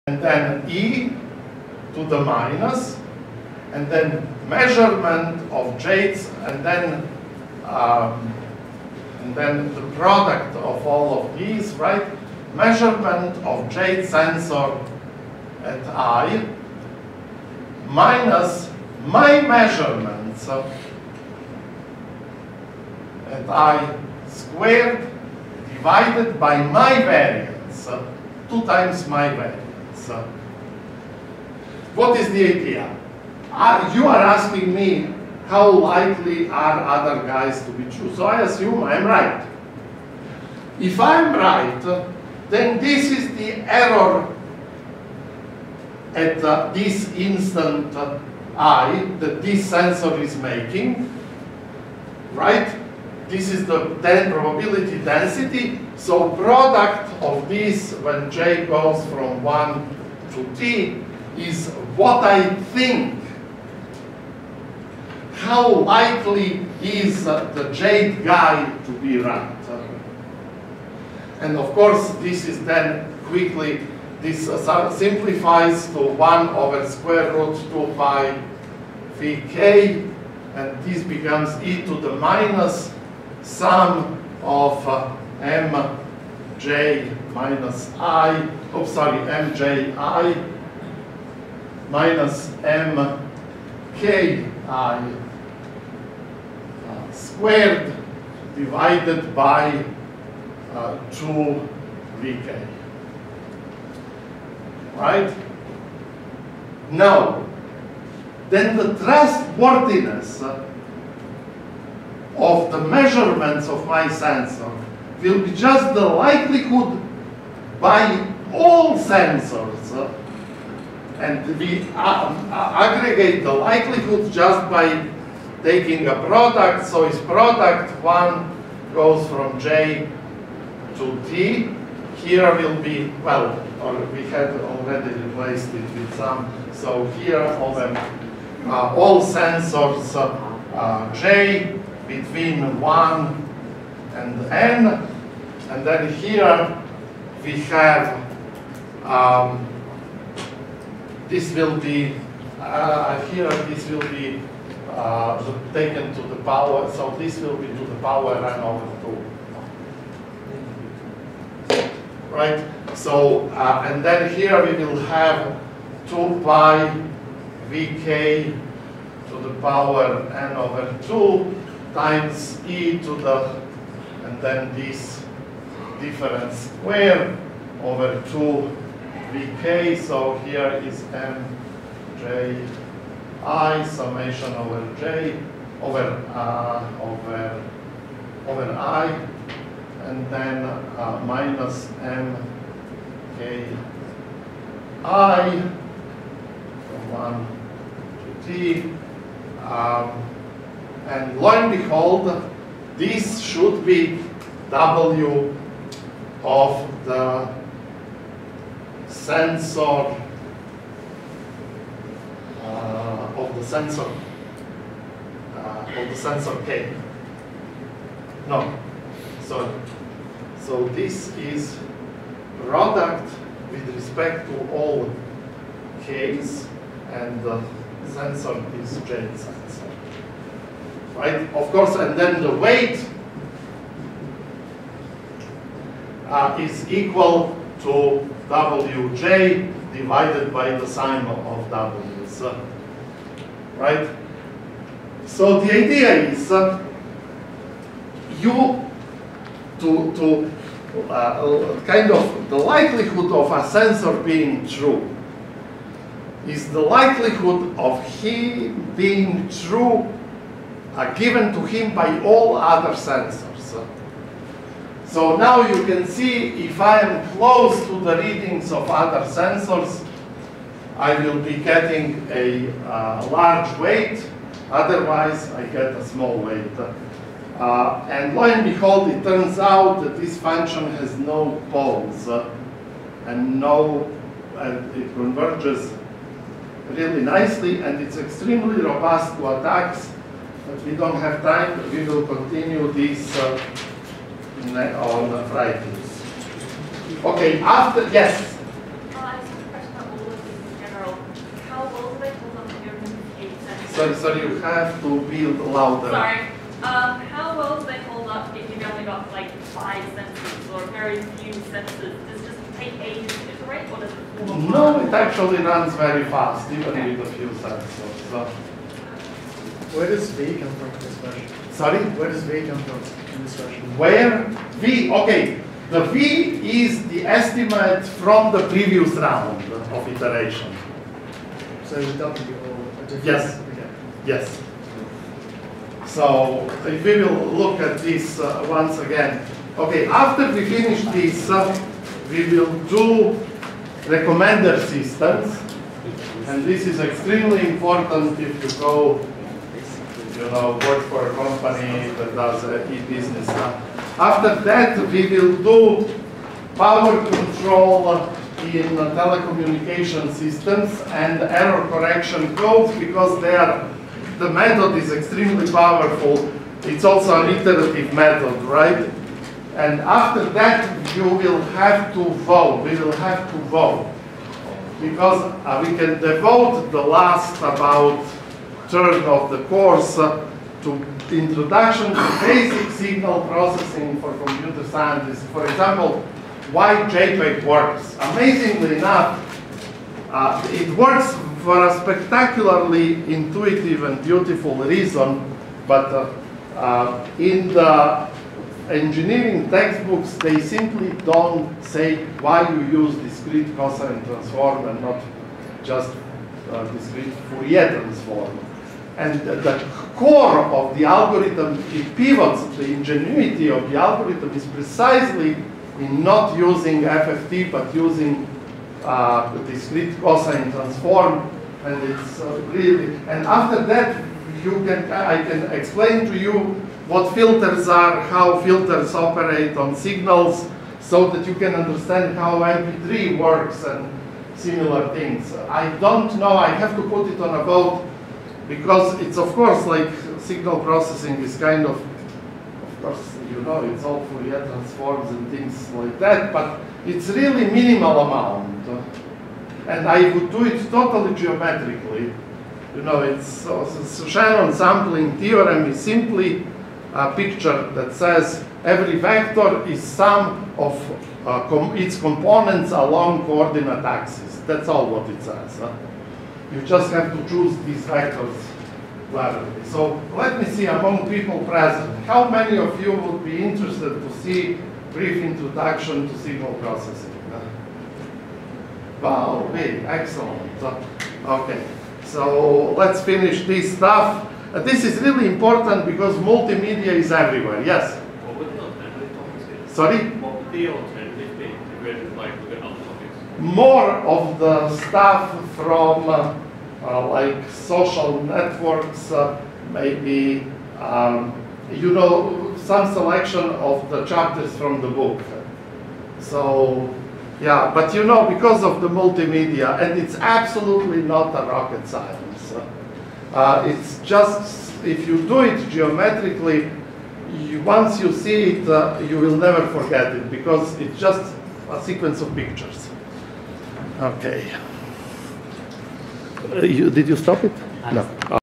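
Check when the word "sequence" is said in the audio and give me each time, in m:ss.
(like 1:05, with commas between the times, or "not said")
8:42.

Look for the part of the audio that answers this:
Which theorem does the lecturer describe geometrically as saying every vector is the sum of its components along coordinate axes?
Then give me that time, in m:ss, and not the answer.
7:34.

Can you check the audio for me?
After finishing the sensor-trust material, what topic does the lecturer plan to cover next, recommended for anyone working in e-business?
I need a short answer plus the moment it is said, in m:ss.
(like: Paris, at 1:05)
recommender systems, at 5:44.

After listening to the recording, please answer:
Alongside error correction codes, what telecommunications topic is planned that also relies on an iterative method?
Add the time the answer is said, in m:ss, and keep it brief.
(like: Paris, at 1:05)
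power control, at 5:56.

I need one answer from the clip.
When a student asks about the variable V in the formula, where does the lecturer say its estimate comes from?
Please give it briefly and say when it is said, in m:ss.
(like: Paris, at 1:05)
the previous round of iteration, at 5:28.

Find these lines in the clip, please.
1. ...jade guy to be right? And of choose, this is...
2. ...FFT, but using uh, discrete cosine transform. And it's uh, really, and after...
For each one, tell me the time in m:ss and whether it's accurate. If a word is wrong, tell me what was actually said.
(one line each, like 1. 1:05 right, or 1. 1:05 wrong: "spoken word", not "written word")
1. 1:07 wrong: "course", not "choose"
2. 6:57 right.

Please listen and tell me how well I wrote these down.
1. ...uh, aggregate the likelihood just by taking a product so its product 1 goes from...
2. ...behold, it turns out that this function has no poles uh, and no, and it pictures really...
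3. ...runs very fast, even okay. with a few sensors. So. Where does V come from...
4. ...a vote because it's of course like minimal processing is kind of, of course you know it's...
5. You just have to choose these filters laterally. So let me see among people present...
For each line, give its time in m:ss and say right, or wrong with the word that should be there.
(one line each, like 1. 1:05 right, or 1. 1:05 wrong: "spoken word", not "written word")
1. 2:02 right
2. 4:38 wrong: "converges", not "pictures"
3. 5:15 right
4. 7:17 wrong: "signal", not "minimal"
5. 7:46 wrong: "vectors", not "filters".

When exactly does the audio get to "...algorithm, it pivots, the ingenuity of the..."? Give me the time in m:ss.
6:51.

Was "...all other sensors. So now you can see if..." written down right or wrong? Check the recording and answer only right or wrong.
right.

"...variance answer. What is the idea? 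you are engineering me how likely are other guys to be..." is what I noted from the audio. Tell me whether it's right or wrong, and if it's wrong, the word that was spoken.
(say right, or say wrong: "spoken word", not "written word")
wrong: "asking", not "engineering".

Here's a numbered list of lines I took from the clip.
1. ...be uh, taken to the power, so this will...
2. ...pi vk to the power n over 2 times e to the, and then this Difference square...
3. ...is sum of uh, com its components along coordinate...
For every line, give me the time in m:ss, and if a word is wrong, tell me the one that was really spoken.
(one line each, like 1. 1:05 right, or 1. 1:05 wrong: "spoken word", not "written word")
1. 2:34 right
2. 2:46 right
3. 7:39 right.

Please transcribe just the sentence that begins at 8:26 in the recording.
So, yeah, but you know, because of the multimedia, and it's absolutely not a rocket science.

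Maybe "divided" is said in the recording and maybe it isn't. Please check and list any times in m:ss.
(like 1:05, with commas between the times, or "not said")
0:25, 1:38, 3:59.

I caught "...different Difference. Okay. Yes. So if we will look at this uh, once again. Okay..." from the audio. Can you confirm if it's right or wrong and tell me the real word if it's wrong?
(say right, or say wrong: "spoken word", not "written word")
wrong: "Yes", not "Difference".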